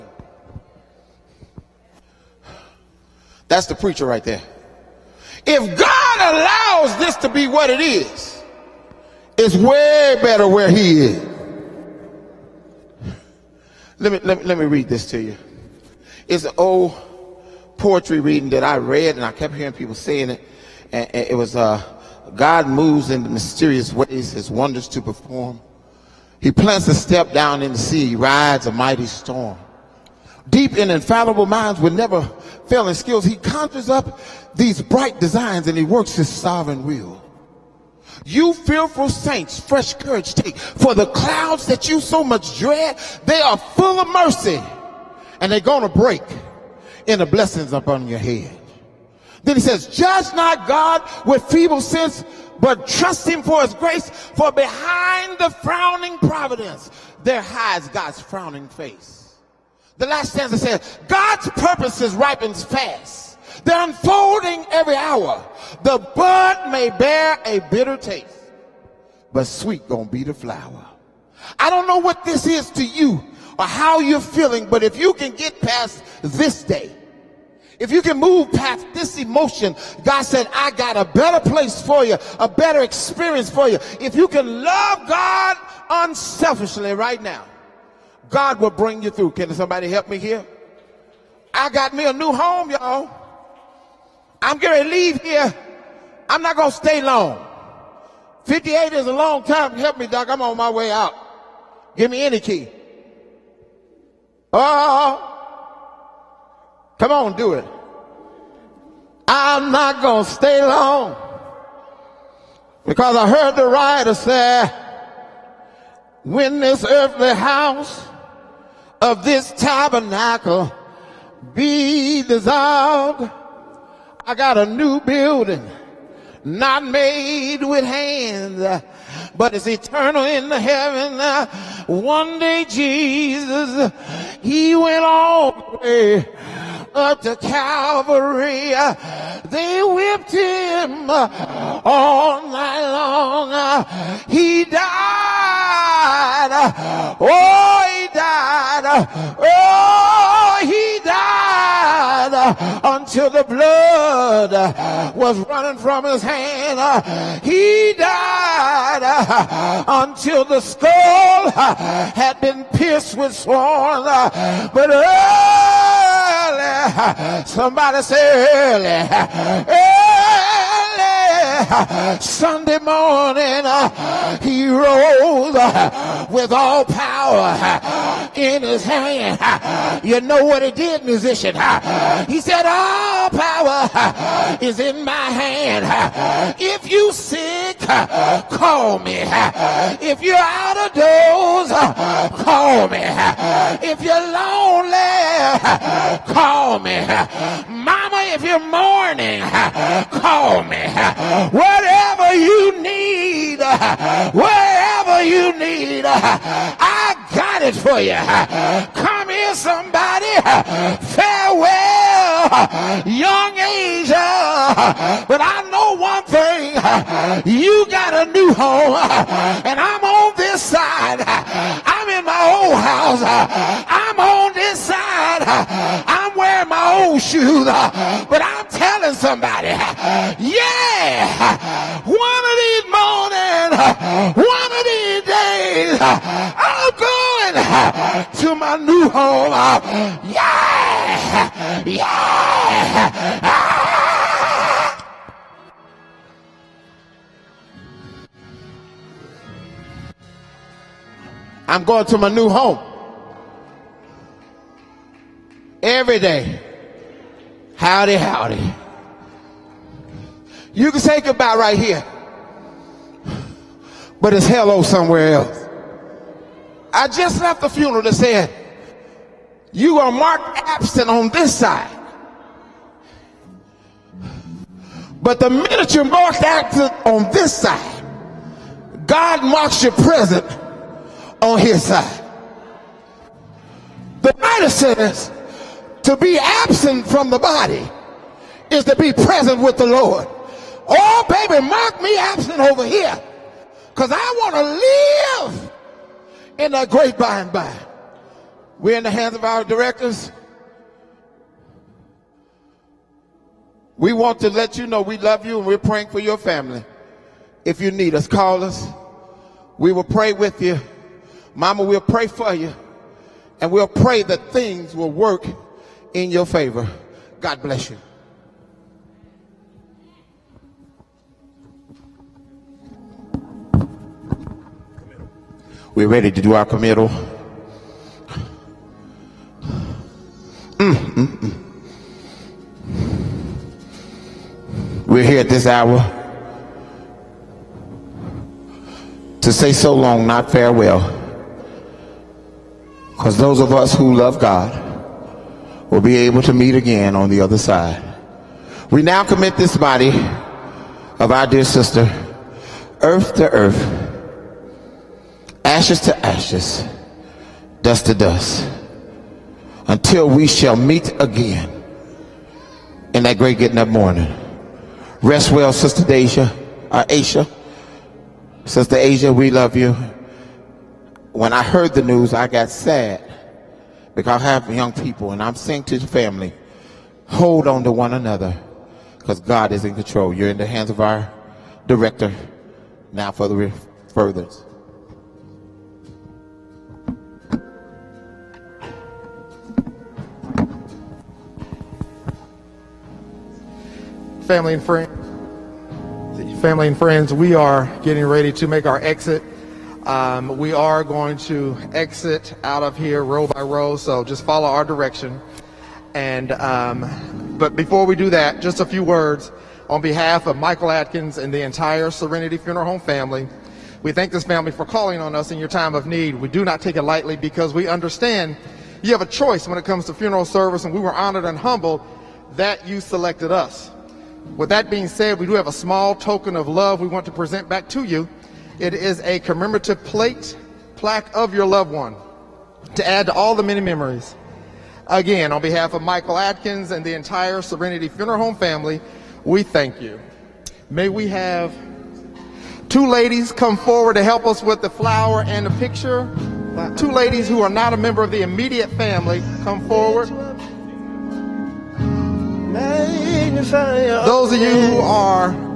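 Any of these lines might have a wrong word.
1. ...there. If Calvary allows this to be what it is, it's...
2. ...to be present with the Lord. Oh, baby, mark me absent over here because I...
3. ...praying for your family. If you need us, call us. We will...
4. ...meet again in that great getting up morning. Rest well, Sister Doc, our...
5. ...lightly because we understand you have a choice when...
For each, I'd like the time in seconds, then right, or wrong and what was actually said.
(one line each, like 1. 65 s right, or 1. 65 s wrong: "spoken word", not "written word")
1. 4 s wrong: "God", not "Calvary"
2. 288 s right
3. 305 s right
4. 360 s wrong: "Asia", not "Doc"
5. 417 s right.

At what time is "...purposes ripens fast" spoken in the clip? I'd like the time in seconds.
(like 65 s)
61 s.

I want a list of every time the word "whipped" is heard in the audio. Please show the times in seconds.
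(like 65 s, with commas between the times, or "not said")
139 s.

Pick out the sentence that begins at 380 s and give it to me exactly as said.
You're in the hands of our director now for the furthers.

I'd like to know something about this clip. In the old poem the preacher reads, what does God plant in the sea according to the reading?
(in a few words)
a step.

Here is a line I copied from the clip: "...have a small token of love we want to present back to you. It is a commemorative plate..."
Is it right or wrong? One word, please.
right.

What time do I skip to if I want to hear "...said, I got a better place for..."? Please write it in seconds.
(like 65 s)
80 s.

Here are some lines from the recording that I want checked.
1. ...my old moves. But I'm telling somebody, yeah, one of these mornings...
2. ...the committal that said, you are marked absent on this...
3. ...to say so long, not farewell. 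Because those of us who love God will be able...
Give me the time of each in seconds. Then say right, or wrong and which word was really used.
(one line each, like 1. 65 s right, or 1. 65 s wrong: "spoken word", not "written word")
1. 226 s wrong: "shoes", not "moves"
2. 267 s wrong: "funeral", not "committal"
3. 339 s right.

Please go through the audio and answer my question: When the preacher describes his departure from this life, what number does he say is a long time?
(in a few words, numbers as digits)
58.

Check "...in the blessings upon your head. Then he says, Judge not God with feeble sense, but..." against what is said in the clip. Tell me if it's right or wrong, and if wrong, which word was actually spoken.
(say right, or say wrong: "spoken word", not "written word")
right.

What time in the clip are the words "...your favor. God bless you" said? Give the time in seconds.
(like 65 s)
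316 s.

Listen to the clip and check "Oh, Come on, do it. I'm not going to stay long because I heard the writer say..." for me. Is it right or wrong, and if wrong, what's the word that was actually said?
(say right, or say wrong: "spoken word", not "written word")
right.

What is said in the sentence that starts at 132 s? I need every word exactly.
One day Jesus, he went all the way up to Calvary.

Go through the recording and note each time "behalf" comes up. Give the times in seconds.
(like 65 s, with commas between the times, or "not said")
410 s, 435 s.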